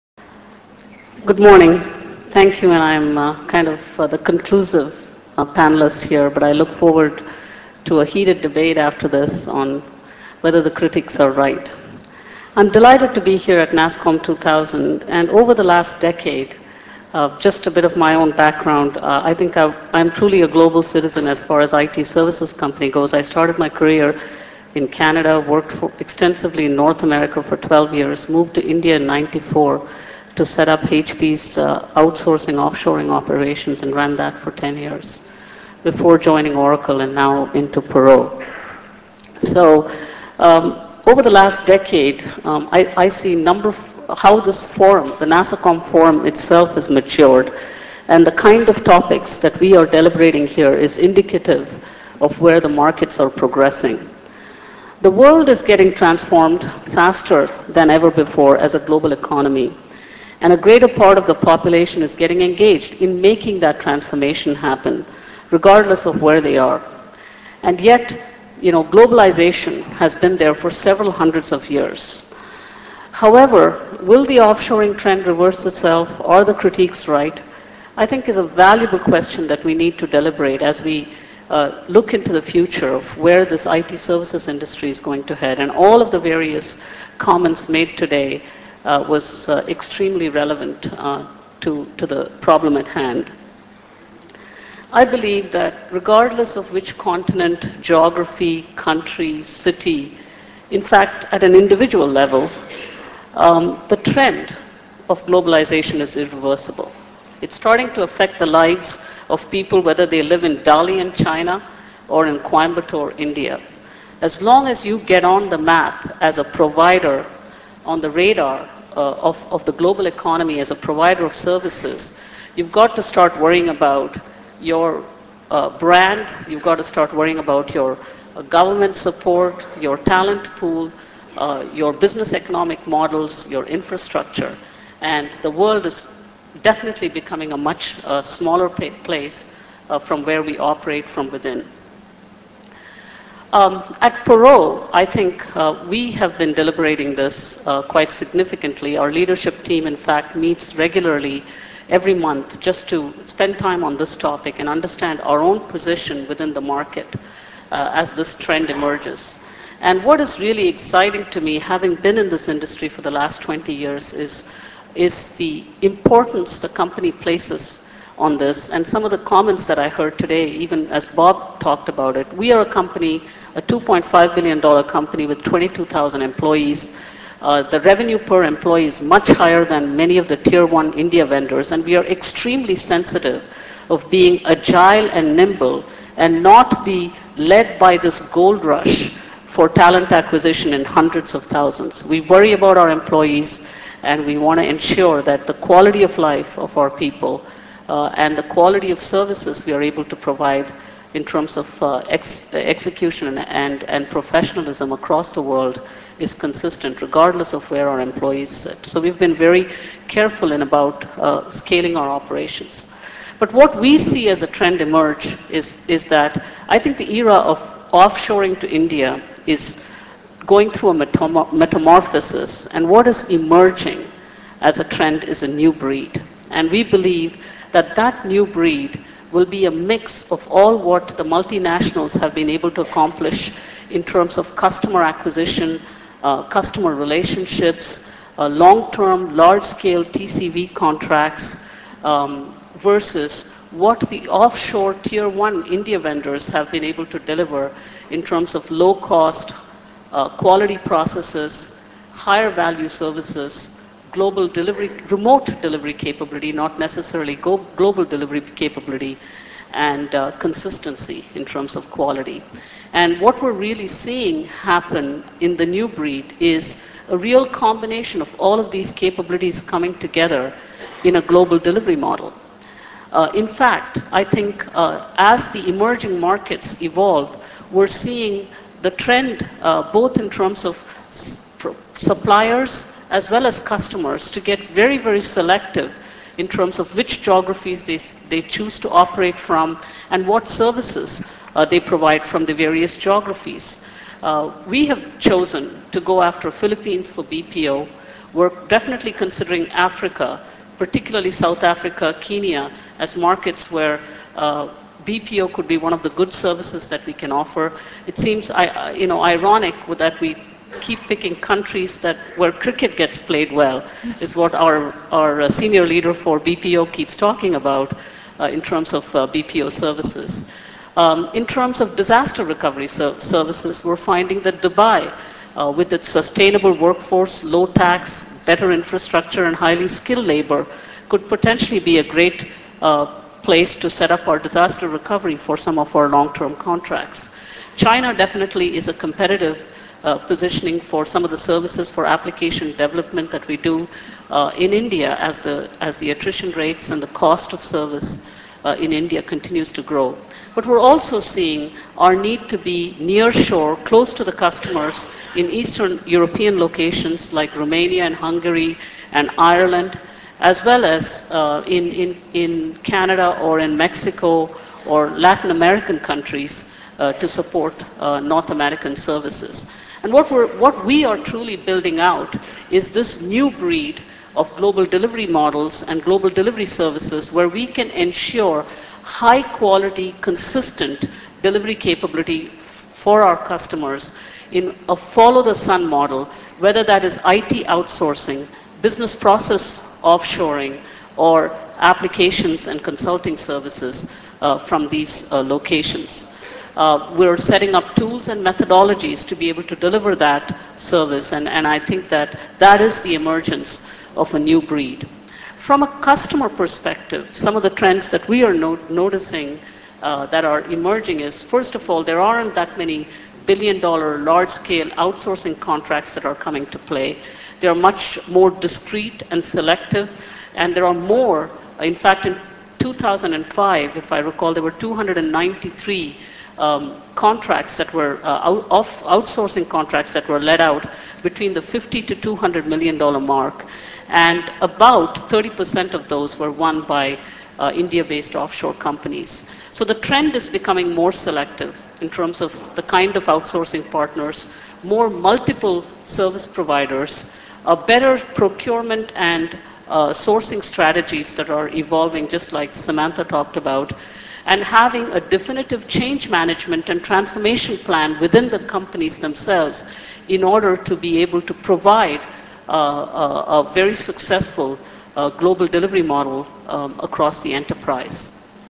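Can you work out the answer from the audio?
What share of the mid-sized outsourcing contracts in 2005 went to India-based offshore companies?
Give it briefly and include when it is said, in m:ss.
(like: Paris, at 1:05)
30%, at 7:15.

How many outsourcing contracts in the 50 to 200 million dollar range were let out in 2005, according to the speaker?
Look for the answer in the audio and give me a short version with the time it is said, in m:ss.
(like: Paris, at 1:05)
293, at 7:04.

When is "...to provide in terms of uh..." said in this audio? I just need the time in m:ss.
3:20.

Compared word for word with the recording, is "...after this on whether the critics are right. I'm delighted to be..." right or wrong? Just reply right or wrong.
right.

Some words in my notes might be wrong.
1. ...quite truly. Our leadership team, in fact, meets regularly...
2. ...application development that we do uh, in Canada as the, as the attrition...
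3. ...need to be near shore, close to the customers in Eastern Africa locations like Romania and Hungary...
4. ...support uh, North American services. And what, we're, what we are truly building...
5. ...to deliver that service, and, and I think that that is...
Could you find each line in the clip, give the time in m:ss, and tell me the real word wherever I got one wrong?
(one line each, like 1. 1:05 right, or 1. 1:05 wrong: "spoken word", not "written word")
1. 2:27 wrong: "significantly", not "truly"
2. 5:42 wrong: "India", not "Canada"
3. 5:52 wrong: "European", not "Africa"
4. 6:07 right
5. 6:39 right.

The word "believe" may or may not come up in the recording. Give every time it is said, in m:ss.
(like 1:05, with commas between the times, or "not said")
1:35, 3:46.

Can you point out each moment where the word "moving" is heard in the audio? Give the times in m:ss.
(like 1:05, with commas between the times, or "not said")
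not said.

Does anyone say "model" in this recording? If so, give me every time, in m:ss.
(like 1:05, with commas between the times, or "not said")
2:12, 4:31, 6:15, 6:25, 7:46.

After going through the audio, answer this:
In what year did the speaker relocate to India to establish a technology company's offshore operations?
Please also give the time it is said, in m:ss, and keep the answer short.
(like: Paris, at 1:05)
1994, at 0:29.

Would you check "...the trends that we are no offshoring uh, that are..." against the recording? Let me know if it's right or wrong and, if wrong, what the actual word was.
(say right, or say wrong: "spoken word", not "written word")
wrong: "noticing", not "offshoring".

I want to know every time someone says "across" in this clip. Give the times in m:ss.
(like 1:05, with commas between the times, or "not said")
3:24, 7:47.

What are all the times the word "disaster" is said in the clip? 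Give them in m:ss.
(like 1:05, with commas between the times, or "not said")
5:21, 5:34.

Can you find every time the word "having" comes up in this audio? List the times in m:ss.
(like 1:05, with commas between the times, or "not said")
2:41, 7:34.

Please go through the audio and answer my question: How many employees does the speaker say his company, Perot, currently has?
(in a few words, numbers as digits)
22,000.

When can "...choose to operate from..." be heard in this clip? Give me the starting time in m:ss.
4:48.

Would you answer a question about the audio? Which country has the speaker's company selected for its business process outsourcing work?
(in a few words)
Philippines.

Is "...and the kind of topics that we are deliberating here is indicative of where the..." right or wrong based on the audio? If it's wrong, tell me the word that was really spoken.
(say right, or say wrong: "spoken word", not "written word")
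right.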